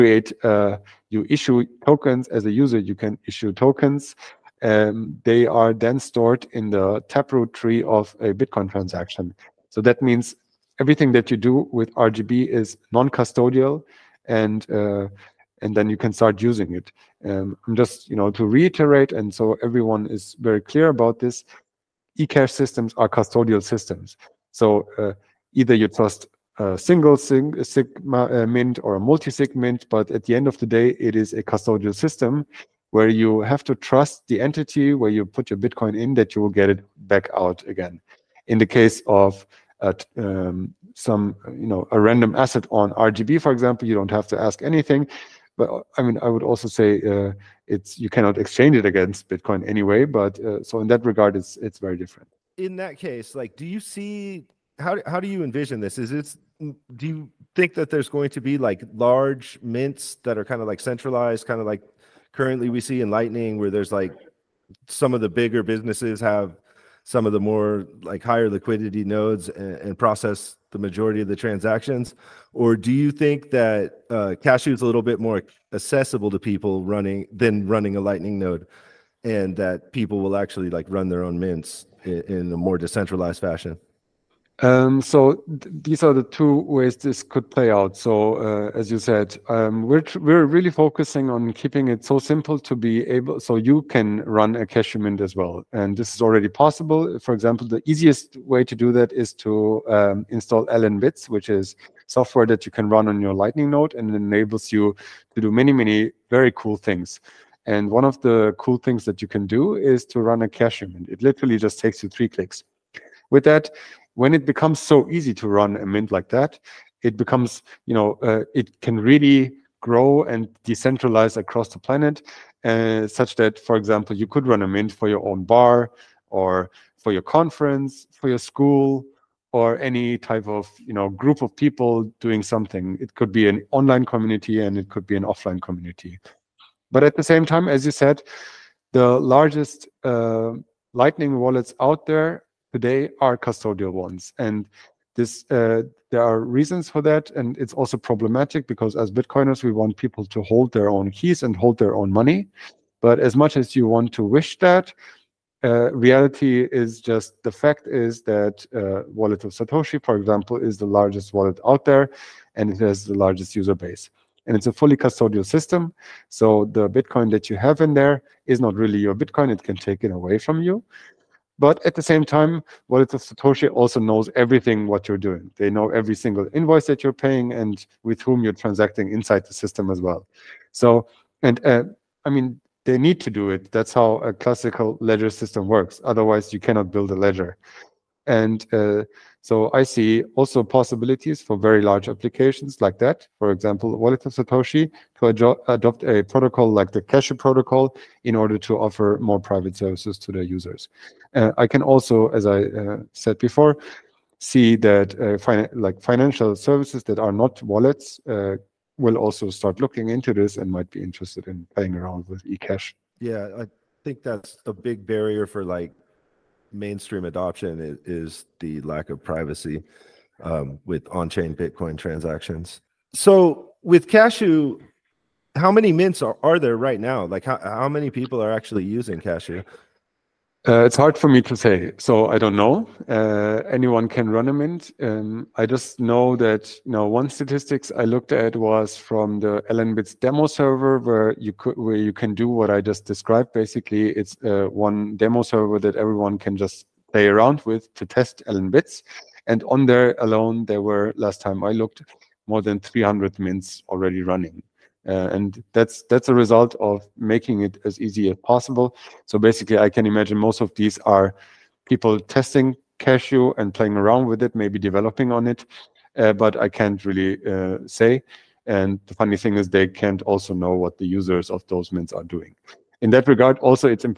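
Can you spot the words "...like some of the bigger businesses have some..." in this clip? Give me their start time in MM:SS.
01:03.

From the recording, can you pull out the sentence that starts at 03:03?
That's how a classical ledger system works.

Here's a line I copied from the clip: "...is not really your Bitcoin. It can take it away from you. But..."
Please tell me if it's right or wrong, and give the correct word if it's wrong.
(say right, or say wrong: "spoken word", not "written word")
right.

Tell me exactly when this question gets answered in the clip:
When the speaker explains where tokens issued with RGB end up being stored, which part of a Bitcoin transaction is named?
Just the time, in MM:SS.
00:07.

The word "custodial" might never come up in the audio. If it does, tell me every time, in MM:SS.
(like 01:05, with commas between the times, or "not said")
00:12, 00:23, 00:31, 02:23, 02:44.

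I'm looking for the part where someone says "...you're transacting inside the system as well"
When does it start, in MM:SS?
02:58.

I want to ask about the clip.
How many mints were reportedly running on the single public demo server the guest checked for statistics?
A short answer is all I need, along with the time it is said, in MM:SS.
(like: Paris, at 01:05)
more than 300, at 04:12.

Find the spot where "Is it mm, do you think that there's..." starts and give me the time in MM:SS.
00:55.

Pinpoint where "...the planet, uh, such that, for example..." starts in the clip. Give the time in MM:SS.
02:01.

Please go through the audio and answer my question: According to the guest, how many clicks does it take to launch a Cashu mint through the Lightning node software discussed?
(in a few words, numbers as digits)
3.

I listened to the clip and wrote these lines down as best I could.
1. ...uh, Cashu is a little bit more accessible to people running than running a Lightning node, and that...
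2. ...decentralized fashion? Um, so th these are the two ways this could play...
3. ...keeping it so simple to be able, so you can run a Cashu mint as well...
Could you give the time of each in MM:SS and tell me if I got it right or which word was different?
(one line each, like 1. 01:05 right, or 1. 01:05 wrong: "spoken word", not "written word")
1. 01:14 right
2. 01:22 right
3. 01:31 right.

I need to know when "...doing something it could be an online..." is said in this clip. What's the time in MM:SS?
02:12.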